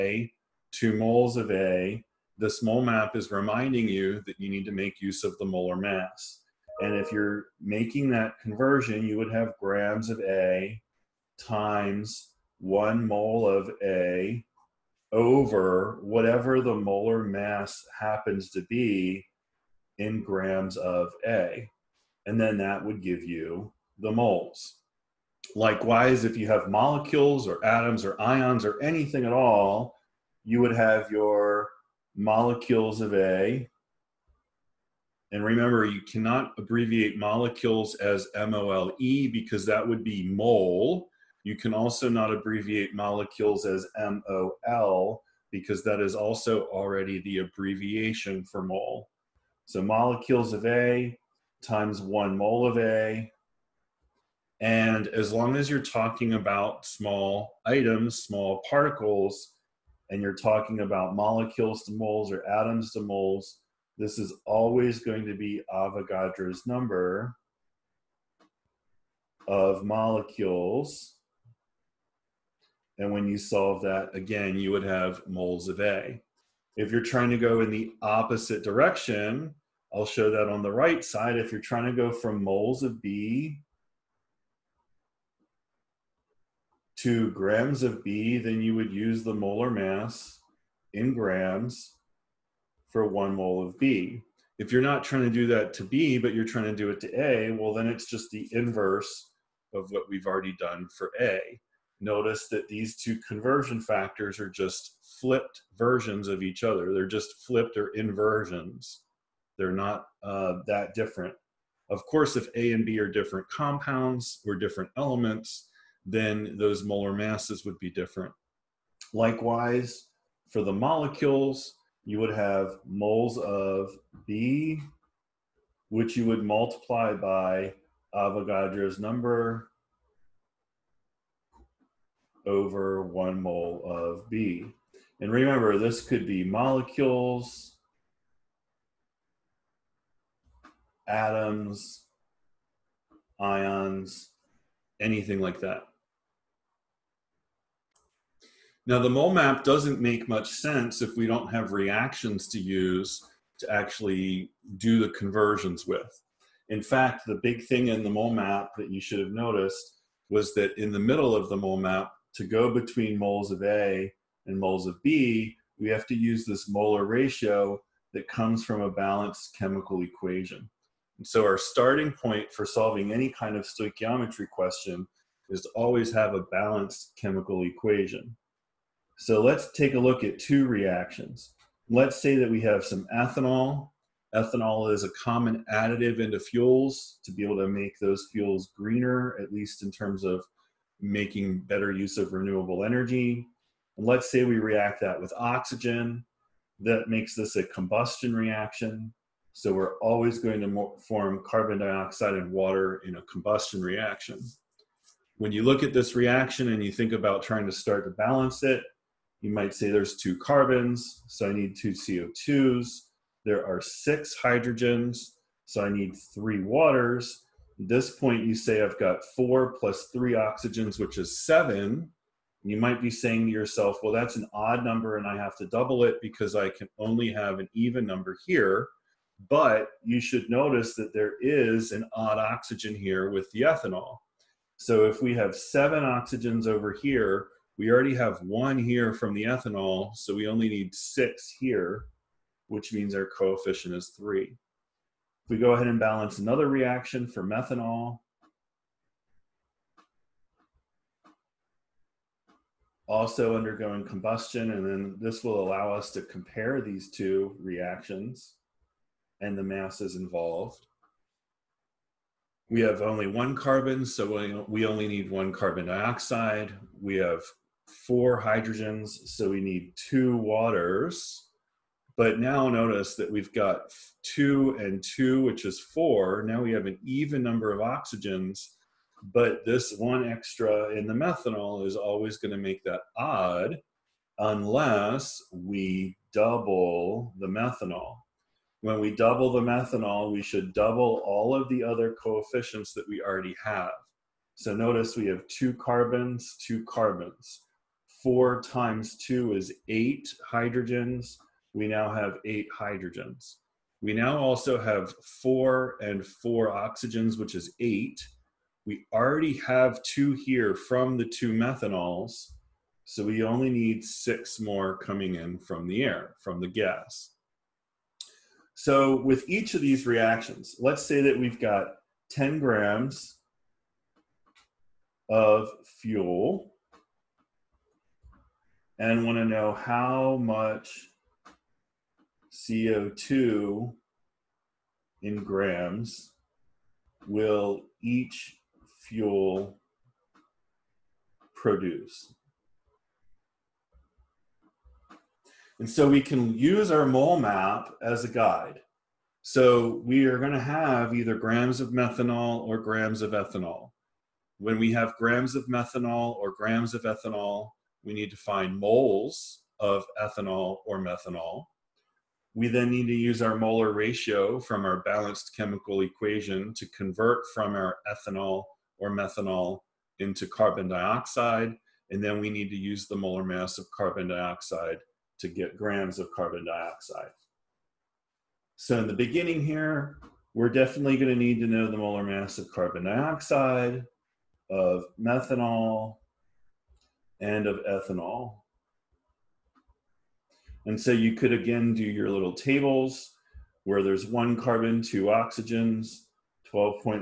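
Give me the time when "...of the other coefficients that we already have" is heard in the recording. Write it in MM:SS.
04:51.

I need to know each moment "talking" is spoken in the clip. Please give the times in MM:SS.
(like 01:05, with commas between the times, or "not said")
00:55, 01:00.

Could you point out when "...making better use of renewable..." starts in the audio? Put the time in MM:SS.
03:11.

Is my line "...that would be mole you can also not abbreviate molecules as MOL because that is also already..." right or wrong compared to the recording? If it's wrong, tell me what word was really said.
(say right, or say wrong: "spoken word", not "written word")
right.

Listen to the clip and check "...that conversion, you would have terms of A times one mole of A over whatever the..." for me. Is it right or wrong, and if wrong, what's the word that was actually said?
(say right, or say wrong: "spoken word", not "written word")
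wrong: "grams", not "terms".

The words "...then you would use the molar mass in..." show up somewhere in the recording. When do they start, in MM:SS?
01:28.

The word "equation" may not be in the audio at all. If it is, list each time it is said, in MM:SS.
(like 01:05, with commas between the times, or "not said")
02:50, 02:57, 06:06.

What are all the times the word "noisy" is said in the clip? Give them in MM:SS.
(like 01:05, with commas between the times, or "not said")
not said.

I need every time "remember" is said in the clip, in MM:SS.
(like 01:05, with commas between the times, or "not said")
00:35, 02:15.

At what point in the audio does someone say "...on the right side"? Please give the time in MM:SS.
01:20.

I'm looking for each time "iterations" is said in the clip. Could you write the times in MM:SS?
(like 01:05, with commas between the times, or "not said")
not said.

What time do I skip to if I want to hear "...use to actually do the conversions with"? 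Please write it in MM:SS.
02:32.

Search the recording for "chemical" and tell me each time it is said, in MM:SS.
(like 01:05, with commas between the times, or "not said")
02:49, 02:57, 06:05.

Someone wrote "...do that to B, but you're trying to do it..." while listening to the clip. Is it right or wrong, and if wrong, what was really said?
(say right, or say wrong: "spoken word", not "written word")
right.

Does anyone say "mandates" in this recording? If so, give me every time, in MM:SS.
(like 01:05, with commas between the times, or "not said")
not said.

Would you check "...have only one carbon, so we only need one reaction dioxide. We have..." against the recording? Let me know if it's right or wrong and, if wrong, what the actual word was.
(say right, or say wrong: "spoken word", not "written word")
wrong: "carbon", not "reaction".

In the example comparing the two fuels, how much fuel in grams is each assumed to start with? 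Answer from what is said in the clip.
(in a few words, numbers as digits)
10 grams.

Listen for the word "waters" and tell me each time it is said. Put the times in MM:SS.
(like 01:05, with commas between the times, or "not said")
03:22, 03:36, 04:30.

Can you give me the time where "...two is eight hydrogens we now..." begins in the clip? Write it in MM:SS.
04:59.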